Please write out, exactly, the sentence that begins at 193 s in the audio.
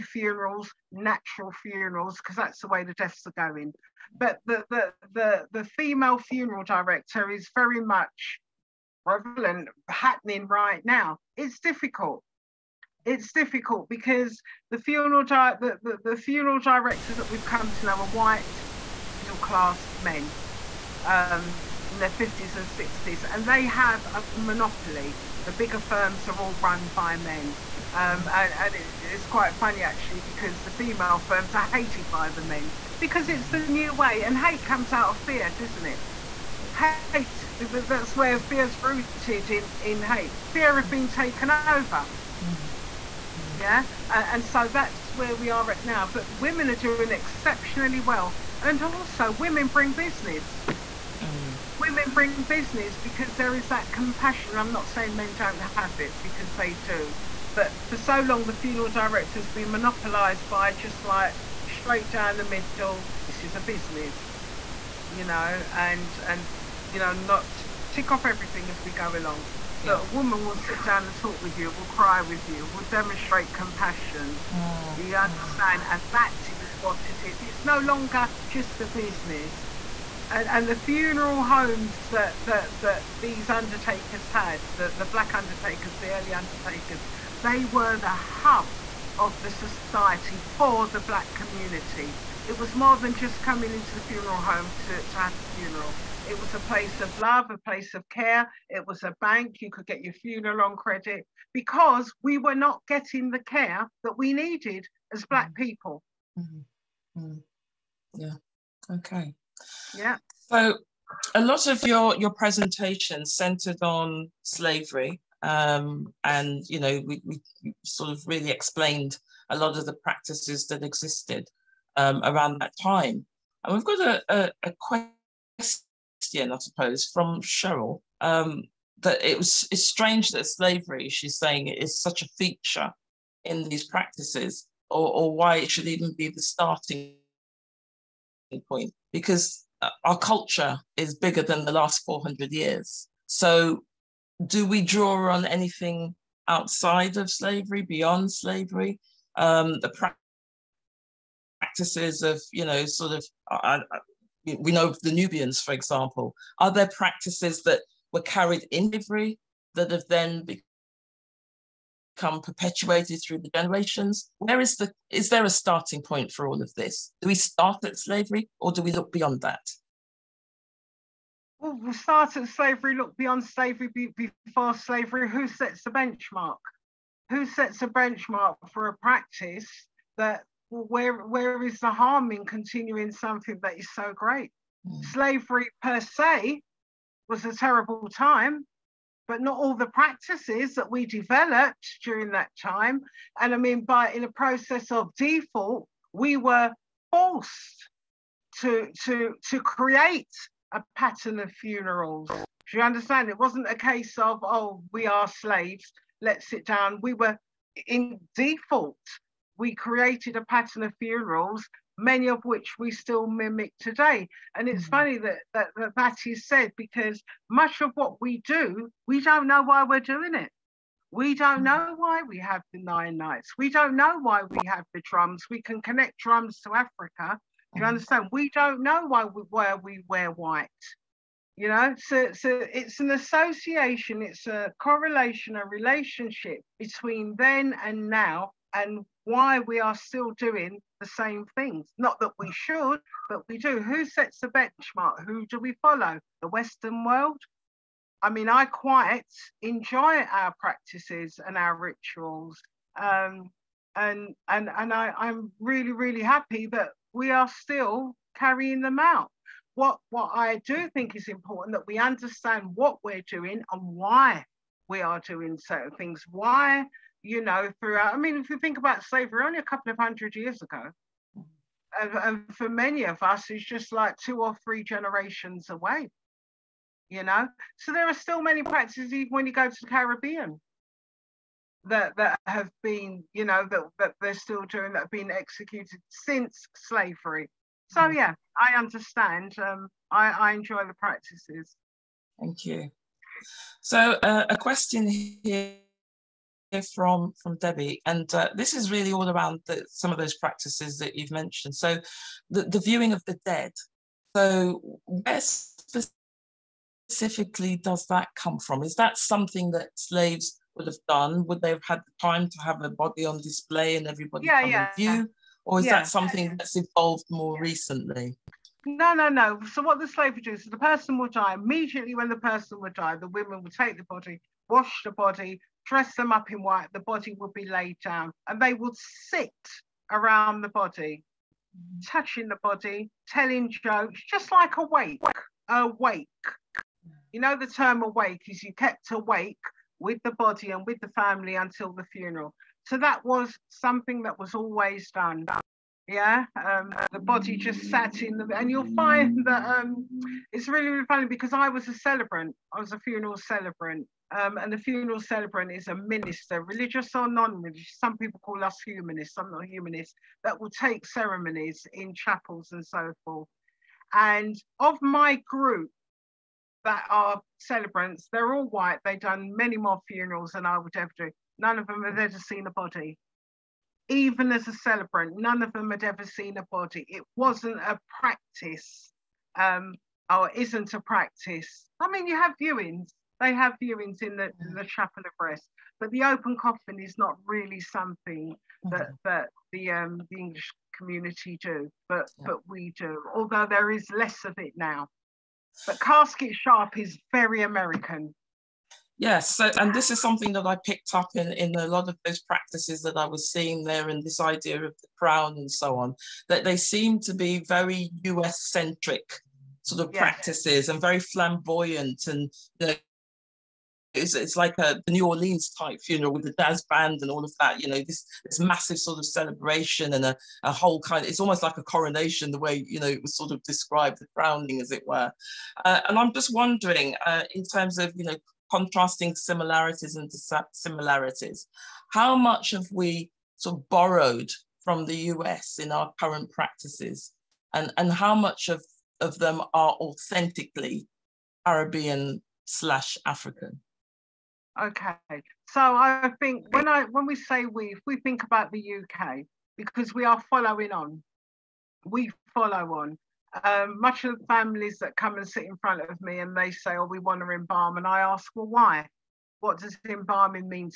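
And I mean, by in a process of default, we were forced to to to create a pattern of funerals.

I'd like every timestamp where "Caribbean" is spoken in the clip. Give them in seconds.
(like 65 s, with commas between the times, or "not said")
279 s, 441 s.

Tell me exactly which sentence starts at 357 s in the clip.
Some people call us humanists, I'm not humanist, that will take ceremonies in chapels and so forth.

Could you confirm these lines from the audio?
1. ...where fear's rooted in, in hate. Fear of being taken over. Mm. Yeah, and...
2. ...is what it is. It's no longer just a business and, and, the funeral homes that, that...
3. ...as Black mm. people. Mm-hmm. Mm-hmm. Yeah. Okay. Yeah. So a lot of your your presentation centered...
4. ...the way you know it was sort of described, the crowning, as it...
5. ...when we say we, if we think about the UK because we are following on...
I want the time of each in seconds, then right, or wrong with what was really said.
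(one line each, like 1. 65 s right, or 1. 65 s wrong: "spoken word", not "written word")
1. 38 s right
2. 76 s right
3. 105 s right
4. 422 s right
5. 447 s right.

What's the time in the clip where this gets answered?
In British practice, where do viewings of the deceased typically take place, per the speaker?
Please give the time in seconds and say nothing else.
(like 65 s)
384 s.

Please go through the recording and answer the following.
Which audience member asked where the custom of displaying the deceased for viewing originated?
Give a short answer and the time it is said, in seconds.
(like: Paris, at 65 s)
Debbie, at 297 s.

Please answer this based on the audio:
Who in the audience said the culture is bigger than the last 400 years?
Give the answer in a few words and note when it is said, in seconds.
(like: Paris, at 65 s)
Cheryl, at 127 s.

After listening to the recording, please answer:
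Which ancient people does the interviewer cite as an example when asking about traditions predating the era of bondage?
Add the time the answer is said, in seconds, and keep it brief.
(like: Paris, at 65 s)
The Nubians, at 155 s.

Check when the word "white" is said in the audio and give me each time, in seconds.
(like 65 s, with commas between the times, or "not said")
18 s, 230 s, 326 s, 368 s.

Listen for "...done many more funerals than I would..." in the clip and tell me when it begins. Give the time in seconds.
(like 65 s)
369 s.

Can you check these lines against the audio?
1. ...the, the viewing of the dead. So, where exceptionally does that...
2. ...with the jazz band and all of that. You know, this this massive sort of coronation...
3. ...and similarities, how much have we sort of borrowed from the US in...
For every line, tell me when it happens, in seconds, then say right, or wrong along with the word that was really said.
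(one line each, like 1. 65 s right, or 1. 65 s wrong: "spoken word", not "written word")
1. 302 s wrong: "specifically", not "exceptionally"
2. 416 s wrong: "celebration", not "coronation"
3. 430 s wrong: "dissimilarities", not "similarities".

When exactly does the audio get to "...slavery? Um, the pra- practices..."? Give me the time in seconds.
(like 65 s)
148 s.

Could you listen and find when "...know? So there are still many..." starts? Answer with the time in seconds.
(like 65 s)
277 s.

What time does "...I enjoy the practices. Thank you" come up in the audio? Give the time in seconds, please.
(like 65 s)
290 s.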